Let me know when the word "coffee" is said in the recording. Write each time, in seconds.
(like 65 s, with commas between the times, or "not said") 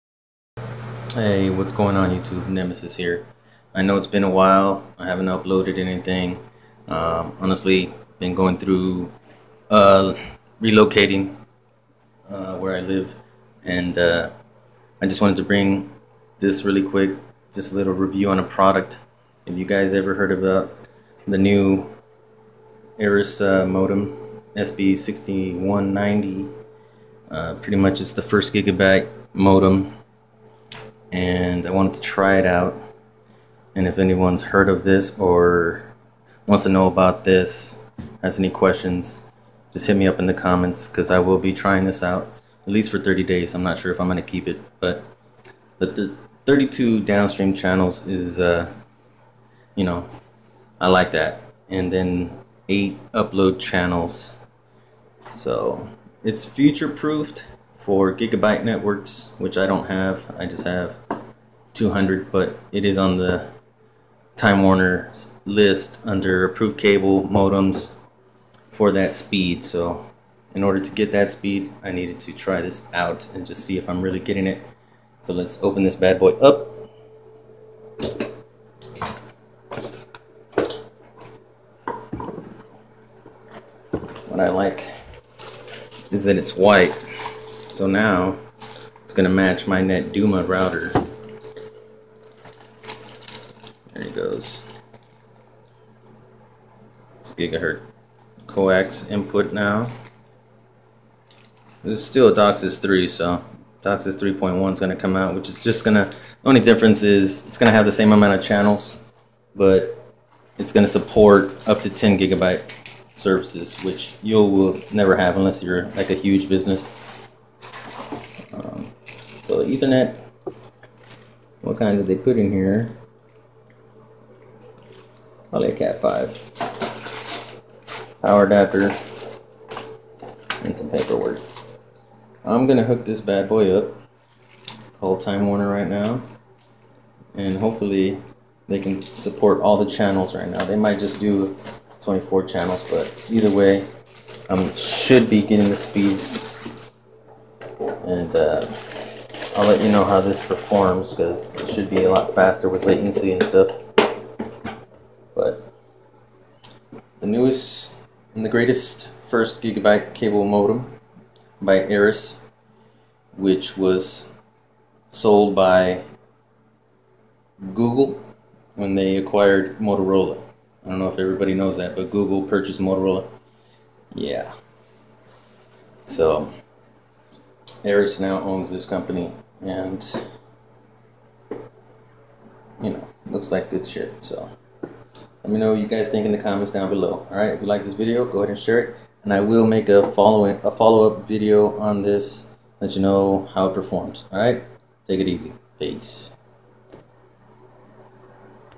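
not said.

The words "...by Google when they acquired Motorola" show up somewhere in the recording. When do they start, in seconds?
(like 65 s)
165 s.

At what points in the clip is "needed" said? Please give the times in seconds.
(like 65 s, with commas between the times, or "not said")
71 s.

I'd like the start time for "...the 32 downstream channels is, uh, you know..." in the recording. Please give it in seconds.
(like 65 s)
45 s.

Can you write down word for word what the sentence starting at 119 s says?
So Ethernet, what kind did they put in here?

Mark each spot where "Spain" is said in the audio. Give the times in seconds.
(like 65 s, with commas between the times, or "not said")
not said.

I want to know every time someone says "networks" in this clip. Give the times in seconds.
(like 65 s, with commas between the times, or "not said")
58 s.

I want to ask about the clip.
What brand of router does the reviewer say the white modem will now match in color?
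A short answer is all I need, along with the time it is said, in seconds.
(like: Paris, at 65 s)
NetDuma, at 89 s.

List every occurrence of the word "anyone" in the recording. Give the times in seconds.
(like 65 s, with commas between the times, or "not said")
33 s.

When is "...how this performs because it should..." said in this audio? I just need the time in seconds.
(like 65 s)
150 s.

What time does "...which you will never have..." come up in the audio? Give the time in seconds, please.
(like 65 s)
113 s.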